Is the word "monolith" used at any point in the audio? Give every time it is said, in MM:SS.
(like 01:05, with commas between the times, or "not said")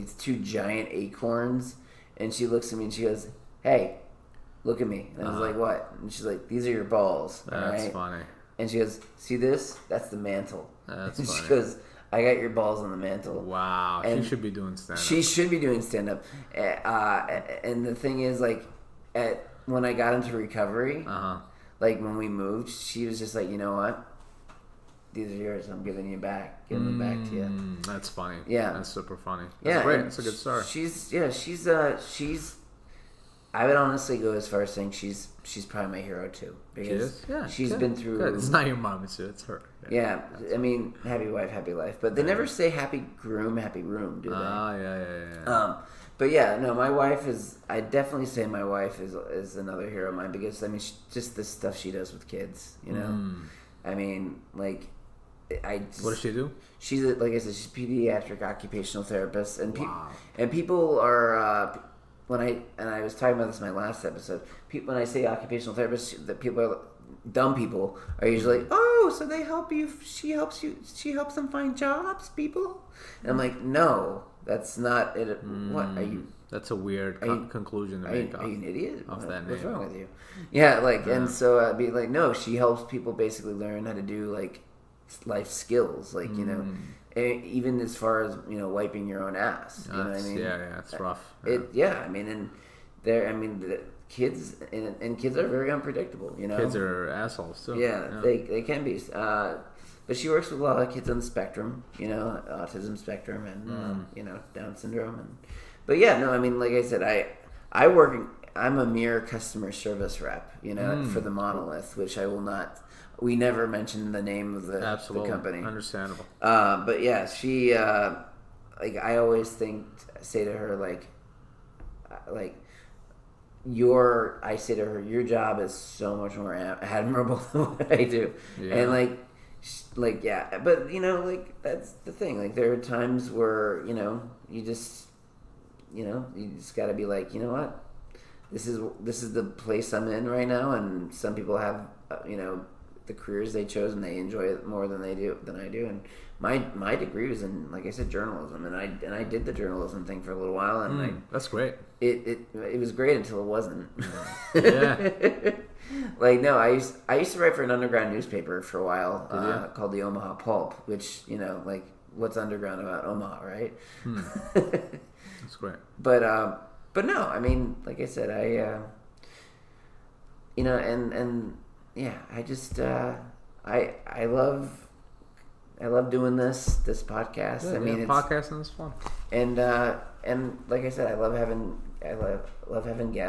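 01:51.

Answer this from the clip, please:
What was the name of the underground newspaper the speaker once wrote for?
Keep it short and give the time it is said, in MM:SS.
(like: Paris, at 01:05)
The Omaha Pulp, at 02:39.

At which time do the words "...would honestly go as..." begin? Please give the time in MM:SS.
00:33.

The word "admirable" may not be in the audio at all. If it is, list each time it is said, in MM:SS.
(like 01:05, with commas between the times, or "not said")
02:06.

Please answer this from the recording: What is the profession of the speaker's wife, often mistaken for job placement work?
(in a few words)
Pediatric occupational therapist.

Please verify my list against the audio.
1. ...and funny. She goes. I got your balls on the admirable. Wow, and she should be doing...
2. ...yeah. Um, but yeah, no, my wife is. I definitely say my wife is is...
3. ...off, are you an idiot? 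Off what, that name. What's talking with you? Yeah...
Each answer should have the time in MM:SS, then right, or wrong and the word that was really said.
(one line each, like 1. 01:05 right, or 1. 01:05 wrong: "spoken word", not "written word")
1. 00:11 wrong: "mantle", not "admirable"
2. 00:45 right
3. 01:18 wrong: "wrong", not "talking".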